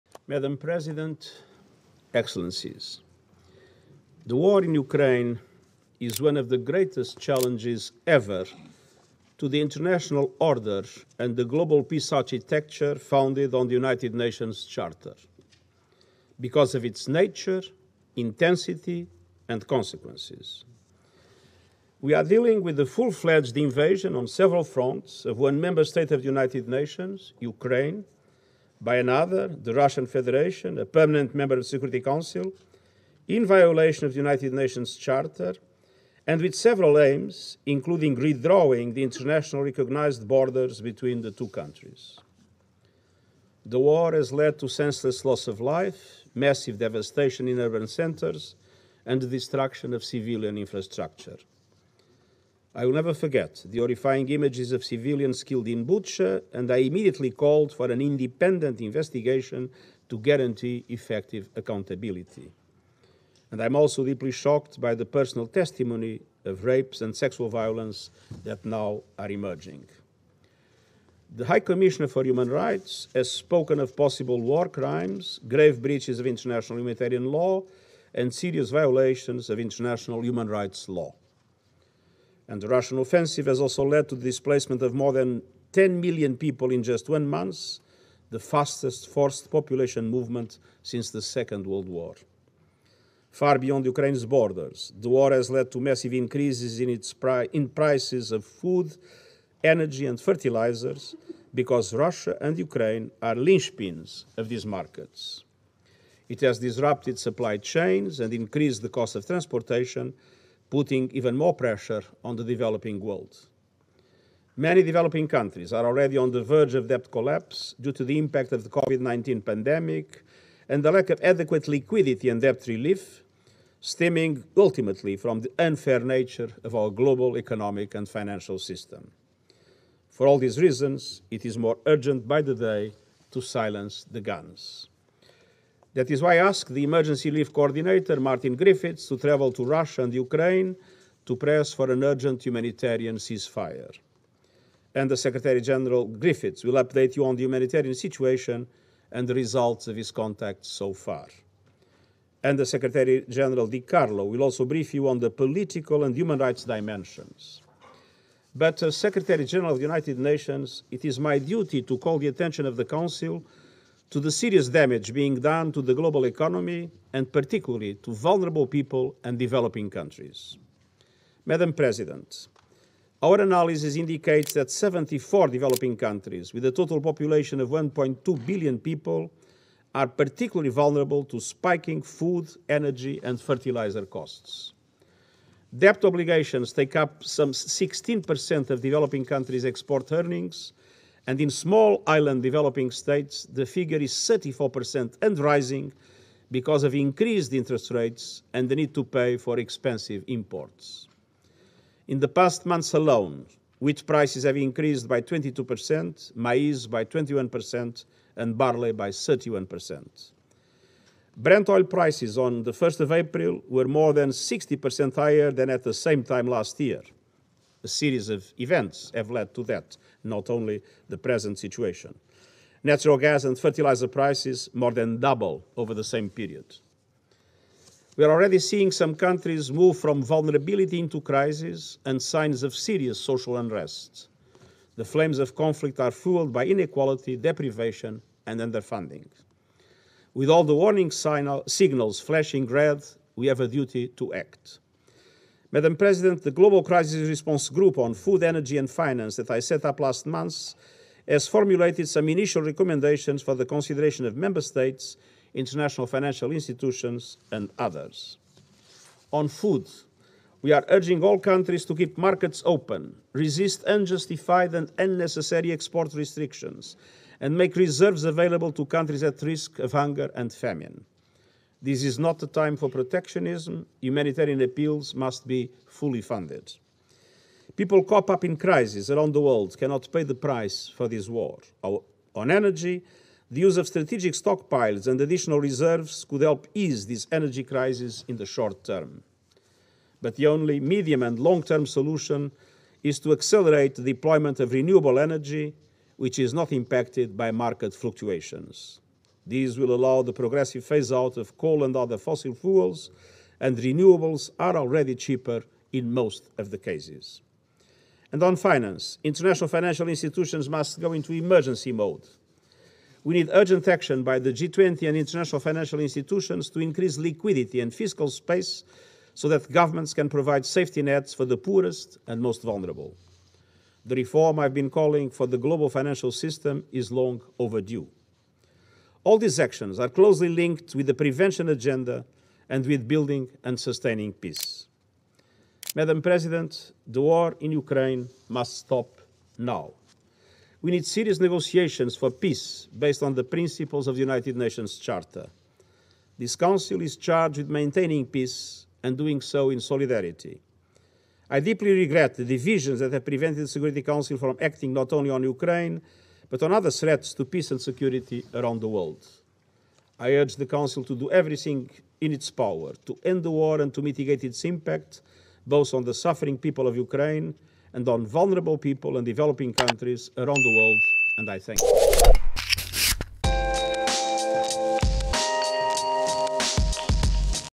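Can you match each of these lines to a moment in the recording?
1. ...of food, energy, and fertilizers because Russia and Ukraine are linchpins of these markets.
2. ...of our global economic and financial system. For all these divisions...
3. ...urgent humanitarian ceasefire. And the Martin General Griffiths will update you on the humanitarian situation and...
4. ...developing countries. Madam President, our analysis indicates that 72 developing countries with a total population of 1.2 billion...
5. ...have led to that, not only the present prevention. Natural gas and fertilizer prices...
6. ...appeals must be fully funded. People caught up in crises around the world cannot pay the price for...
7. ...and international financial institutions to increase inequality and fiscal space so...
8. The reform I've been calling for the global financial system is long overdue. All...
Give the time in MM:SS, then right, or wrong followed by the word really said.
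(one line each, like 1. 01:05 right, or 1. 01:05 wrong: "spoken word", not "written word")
1. 01:38 right
2. 02:06 wrong: "reasons", not "divisions"
3. 02:22 wrong: "Secretary", not "Martin"
4. 02:49 wrong: "74", not "72"
5. 03:39 wrong: "situation", not "prevention"
6. 04:34 right
7. 05:15 wrong: "liquidity", not "inequality"
8. 05:24 right.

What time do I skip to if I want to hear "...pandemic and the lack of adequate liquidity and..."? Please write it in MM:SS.
01:59.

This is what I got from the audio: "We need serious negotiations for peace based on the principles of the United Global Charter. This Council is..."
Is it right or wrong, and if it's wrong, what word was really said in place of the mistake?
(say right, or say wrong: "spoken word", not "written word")
wrong: "Nations", not "Global".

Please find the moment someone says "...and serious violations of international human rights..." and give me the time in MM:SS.
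01:18.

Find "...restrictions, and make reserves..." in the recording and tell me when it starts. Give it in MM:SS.
04:26.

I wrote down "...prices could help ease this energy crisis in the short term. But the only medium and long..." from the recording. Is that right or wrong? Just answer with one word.
wrong.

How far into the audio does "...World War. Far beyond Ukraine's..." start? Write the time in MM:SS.
01:31.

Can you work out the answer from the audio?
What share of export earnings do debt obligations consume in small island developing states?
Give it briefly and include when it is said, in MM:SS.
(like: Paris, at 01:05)
34%, at 03:14.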